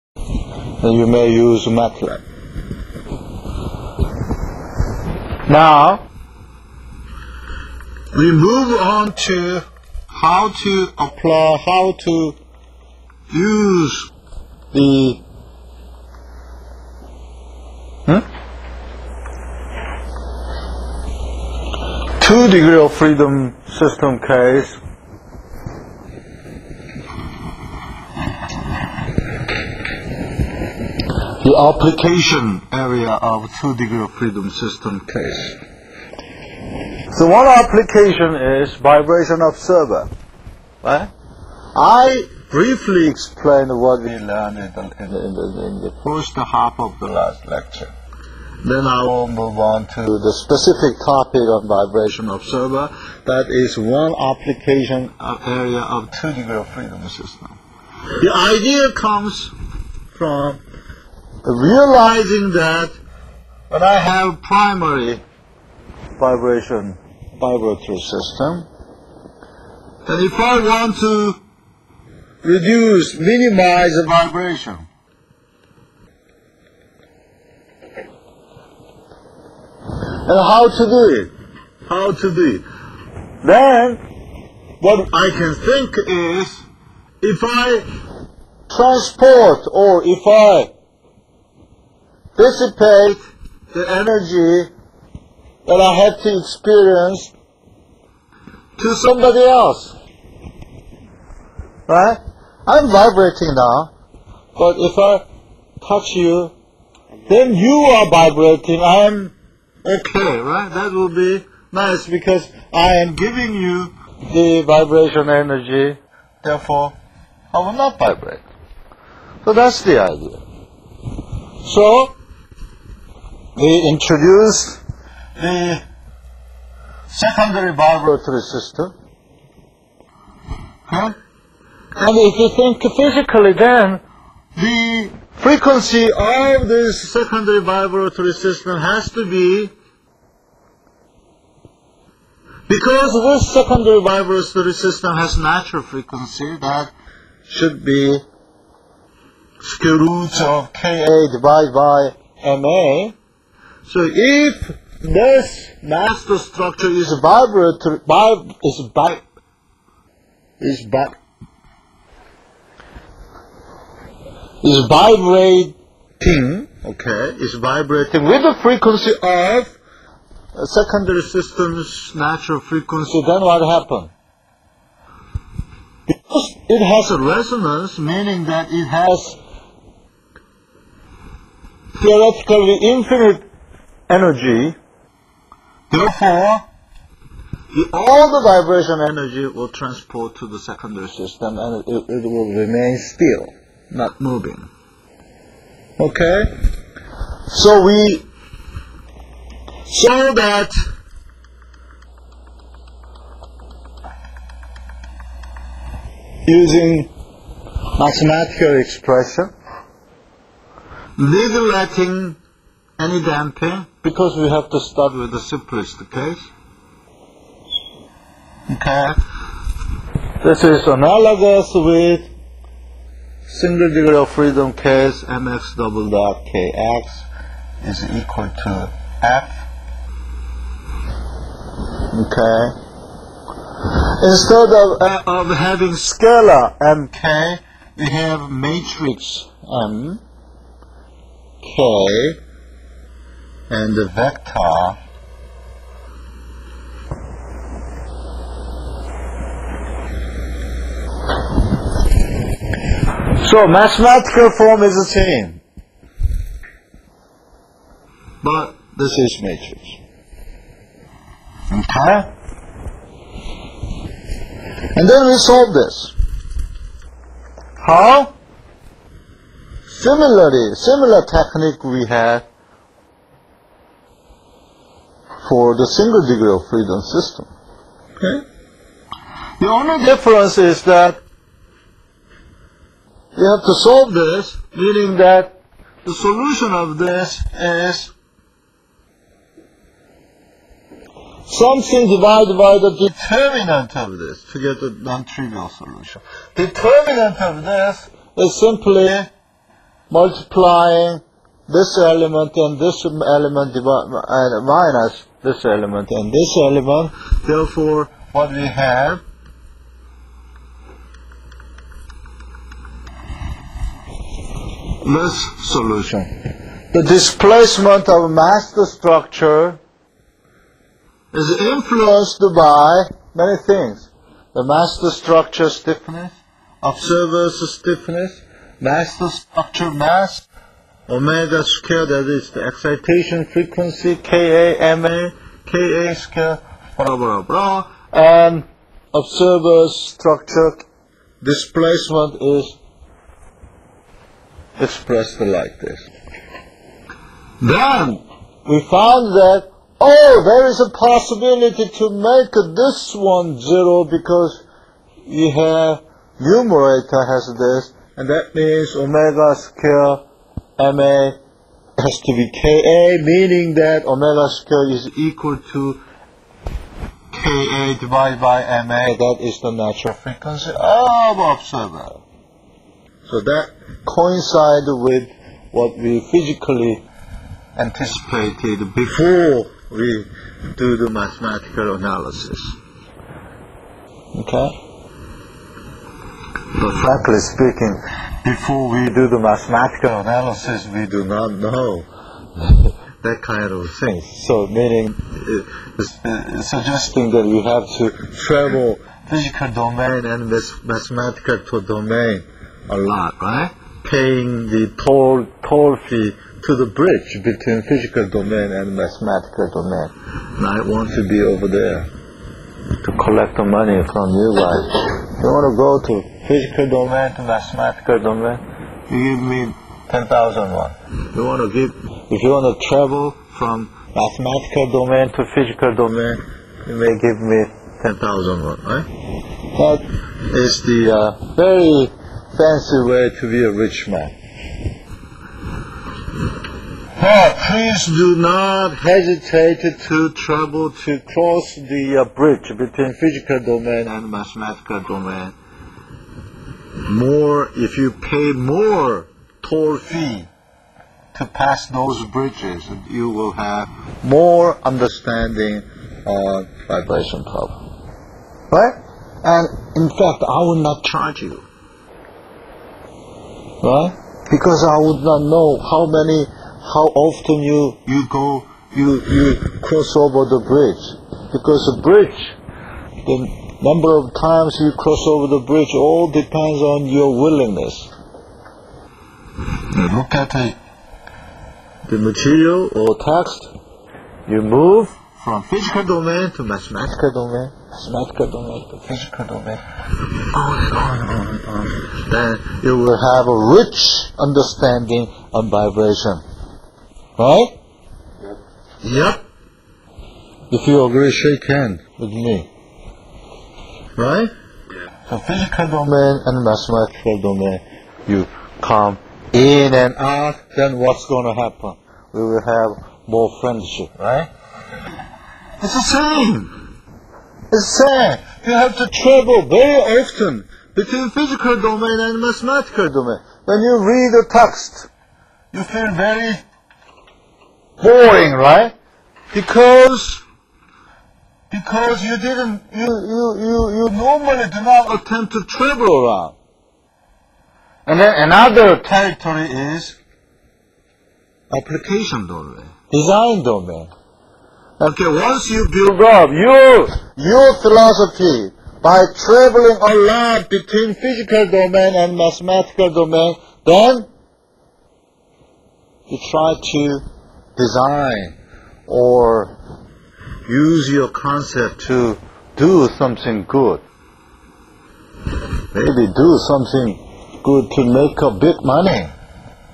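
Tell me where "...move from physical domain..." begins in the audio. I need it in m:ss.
8:04.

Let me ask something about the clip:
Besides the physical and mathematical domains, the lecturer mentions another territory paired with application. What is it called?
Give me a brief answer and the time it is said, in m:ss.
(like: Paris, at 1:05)
Design domain, at 9:03.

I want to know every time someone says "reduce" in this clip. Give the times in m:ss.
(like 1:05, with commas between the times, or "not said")
1:12.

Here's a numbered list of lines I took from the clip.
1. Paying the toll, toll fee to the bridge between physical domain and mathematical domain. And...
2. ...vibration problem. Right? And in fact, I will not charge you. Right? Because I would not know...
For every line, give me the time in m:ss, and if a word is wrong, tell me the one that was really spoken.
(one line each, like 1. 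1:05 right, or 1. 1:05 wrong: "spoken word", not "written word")
1. 6:44 right
2. 7:36 right.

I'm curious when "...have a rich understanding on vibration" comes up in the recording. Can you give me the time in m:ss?
8:13.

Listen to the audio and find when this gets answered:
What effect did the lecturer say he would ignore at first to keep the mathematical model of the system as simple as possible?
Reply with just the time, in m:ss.
3:33.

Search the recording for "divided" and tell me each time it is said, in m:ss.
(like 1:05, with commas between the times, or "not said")
2:31, 4:52, 6:07.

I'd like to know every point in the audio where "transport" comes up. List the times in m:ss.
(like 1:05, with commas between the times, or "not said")
1:28, 3:09.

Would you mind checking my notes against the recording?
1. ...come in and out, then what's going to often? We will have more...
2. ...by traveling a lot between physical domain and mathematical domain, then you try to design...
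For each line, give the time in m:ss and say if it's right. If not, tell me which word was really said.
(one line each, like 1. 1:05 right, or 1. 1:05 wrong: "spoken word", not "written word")
1. 8:28 wrong: "happen", not "often"
2. 9:09 right.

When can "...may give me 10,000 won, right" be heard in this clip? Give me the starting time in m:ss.
7:06.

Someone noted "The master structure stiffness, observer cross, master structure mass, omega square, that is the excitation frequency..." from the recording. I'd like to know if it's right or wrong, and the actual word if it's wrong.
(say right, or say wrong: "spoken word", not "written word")
wrong: "stiffness", not "cross".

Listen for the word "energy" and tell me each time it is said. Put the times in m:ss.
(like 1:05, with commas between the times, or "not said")
1:33, 1:55, 3:04, 3:09.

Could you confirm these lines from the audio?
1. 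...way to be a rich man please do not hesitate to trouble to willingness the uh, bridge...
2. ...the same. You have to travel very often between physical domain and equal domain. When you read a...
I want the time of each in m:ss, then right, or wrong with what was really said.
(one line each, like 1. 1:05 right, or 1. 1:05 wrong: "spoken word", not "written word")
1. 7:13 wrong: "cross", not "willingness"
2. 8:37 wrong: "mathematical", not "equal".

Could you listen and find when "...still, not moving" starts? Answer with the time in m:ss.
3:12.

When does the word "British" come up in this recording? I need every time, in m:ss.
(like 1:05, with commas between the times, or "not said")
not said.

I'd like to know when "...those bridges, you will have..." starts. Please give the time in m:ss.
7:31.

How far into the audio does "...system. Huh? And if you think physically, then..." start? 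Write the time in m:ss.
2:08.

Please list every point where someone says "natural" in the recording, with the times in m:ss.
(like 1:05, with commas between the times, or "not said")
2:25, 2:52, 6:09.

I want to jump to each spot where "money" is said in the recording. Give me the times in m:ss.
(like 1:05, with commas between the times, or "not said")
6:53, 9:28.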